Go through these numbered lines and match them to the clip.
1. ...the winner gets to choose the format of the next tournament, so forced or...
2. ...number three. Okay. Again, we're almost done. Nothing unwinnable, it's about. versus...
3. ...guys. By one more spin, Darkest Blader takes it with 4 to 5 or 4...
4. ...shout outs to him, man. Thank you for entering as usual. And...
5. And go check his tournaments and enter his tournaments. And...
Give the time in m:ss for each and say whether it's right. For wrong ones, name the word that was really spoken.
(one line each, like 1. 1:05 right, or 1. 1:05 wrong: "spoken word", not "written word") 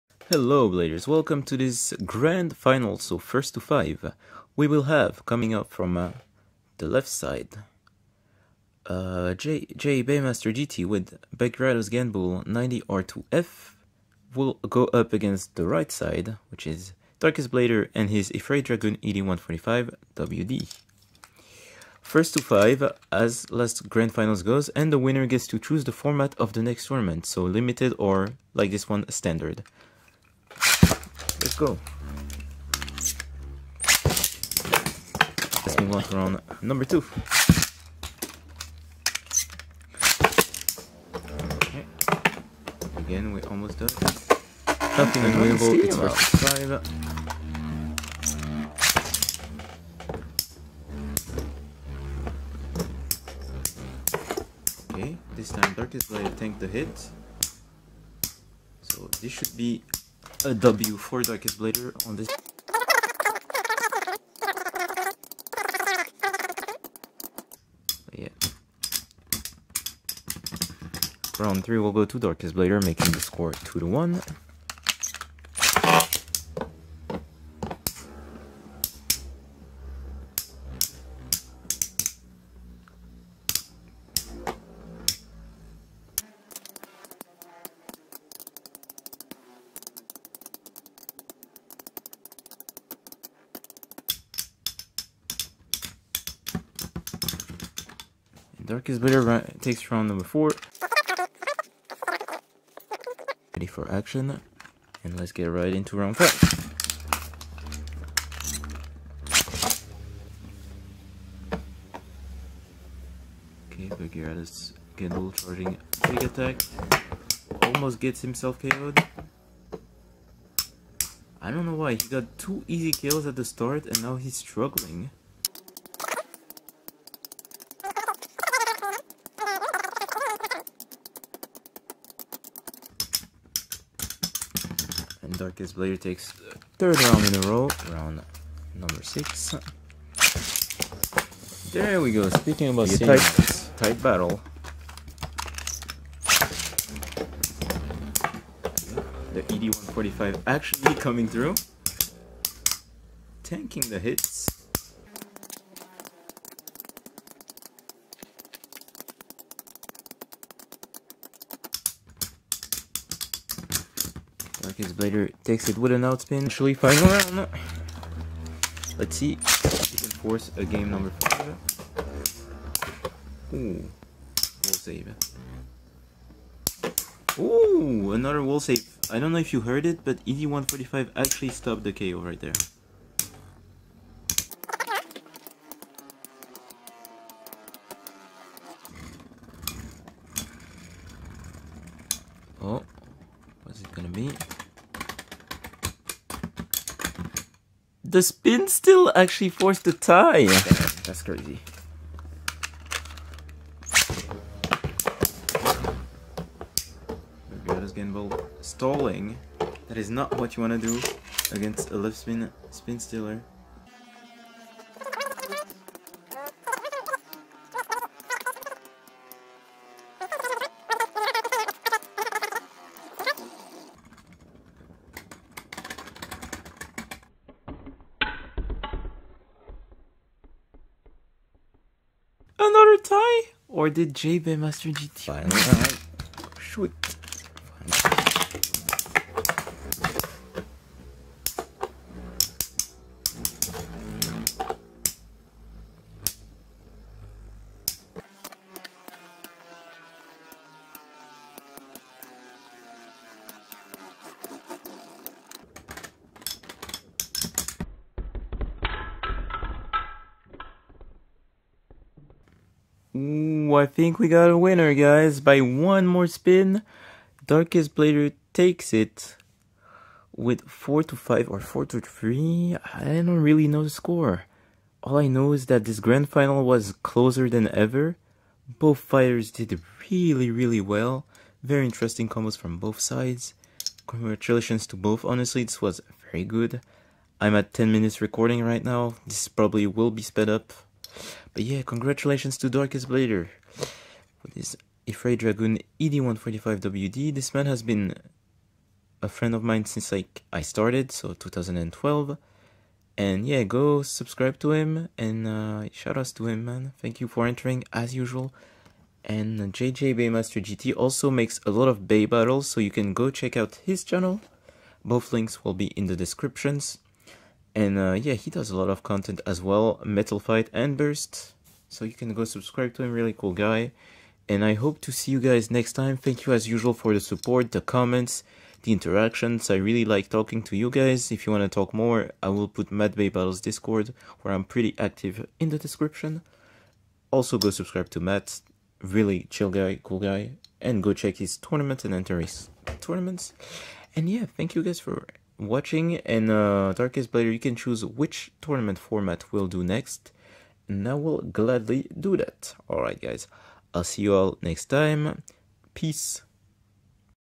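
1. 0:24 wrong: "limited", not "forced"
2. 0:36 wrong: "two", not "three"
3. 4:24 right
4. 5:05 right
5. 5:40 right.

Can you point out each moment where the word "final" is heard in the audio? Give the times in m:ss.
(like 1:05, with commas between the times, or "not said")
0:02, 0:24, 2:46, 4:36.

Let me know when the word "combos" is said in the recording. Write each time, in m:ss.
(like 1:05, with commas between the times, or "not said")
4:42.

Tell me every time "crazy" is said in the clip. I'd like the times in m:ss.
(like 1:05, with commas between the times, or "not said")
3:21.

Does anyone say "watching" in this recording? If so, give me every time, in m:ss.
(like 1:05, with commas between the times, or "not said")
5:45.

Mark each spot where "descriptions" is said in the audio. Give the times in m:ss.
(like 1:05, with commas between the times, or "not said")
5:16, 5:35.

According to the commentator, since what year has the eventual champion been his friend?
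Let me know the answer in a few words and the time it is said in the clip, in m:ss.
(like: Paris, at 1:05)
2012, at 5:01.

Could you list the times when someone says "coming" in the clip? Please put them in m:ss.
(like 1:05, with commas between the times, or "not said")
0:05, 2:30.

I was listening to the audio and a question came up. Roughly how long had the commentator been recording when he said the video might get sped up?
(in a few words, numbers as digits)
10 minutes.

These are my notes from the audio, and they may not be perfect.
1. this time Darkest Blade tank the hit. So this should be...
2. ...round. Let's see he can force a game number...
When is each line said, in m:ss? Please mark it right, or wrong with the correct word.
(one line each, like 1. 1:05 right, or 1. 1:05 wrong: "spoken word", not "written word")
1. 0:55 right
2. 2:47 right.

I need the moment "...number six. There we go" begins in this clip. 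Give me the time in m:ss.
2:18.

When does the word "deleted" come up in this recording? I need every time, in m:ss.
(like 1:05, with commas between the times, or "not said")
not said.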